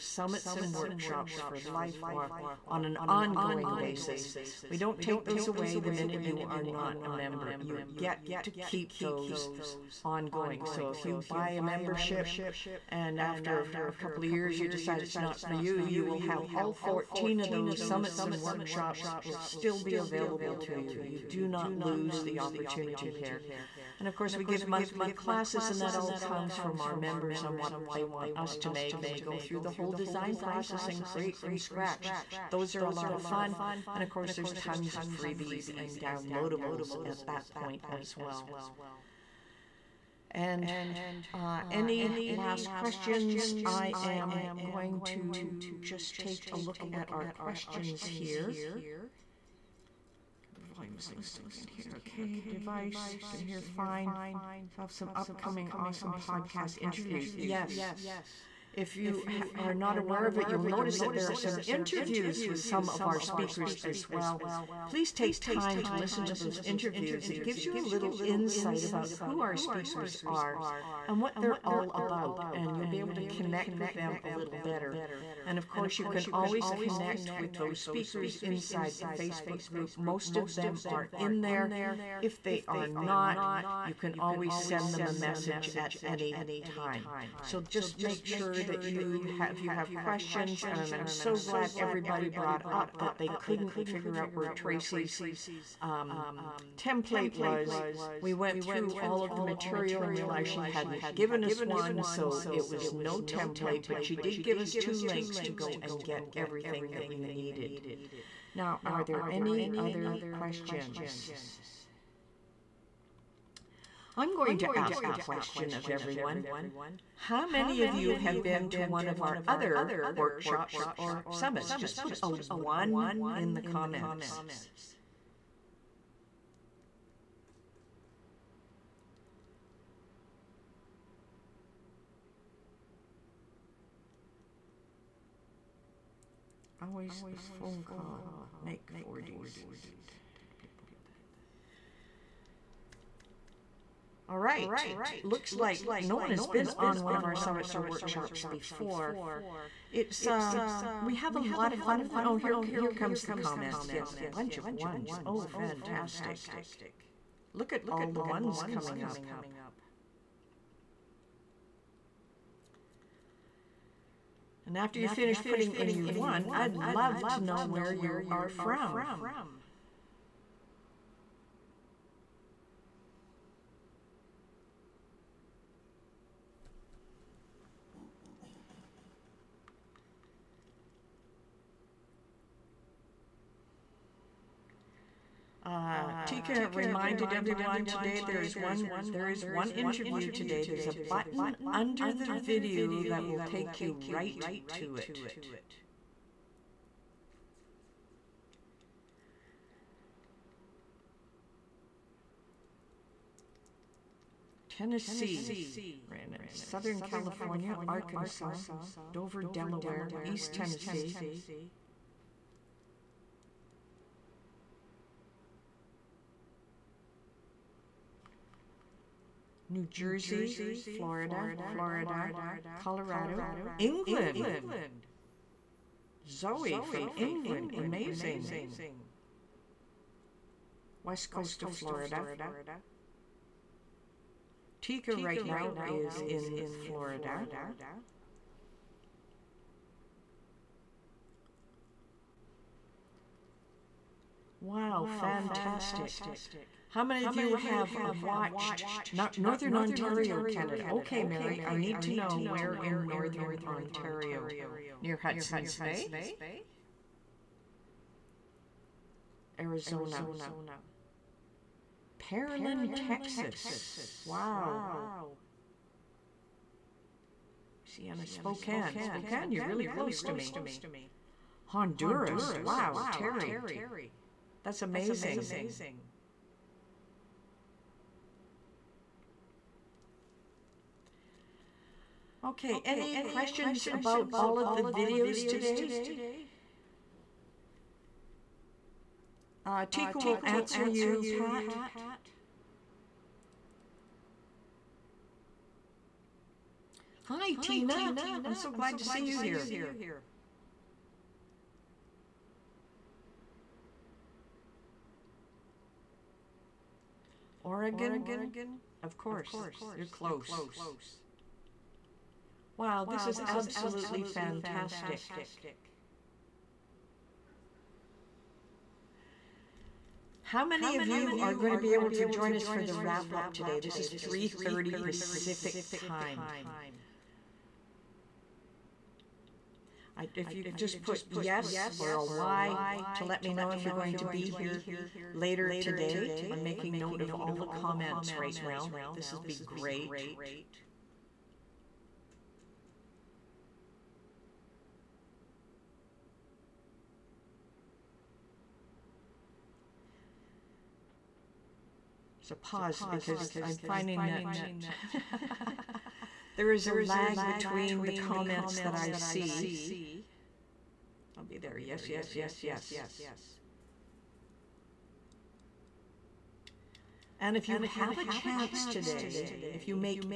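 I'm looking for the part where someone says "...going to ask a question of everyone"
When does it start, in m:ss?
1:54.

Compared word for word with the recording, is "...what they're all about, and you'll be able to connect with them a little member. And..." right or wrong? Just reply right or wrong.
wrong.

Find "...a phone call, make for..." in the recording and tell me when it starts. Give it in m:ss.
2:17.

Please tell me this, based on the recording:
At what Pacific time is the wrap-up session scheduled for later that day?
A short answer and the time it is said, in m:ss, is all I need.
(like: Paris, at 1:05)
3:30, at 5:24.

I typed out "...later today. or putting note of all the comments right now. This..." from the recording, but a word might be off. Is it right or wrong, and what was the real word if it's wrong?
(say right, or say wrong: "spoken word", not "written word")
wrong: "making", not "putting".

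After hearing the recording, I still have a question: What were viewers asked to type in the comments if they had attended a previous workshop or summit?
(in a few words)
1.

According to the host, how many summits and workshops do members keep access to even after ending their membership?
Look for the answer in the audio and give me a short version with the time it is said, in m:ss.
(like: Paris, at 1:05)
14, at 0:16.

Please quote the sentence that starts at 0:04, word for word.
We don't take those away the minute you are not a member.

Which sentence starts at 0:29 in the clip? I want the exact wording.
And we go through the whole design process and create from scratch.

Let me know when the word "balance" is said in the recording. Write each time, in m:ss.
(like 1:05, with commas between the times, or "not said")
not said.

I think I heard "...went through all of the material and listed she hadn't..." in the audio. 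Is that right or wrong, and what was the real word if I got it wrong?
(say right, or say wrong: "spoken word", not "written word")
wrong: "realized", not "listed".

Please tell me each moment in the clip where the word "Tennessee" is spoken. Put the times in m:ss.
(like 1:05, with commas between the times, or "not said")
3:24, 3:30.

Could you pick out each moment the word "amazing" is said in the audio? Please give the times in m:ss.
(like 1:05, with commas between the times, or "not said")
3:47, 4:34.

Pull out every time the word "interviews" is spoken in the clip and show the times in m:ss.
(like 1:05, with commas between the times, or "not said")
0:56, 1:01, 1:06, 3:09.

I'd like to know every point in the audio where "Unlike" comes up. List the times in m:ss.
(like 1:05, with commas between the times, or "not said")
not said.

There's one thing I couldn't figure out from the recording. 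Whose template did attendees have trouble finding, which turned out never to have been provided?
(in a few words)
Tracy.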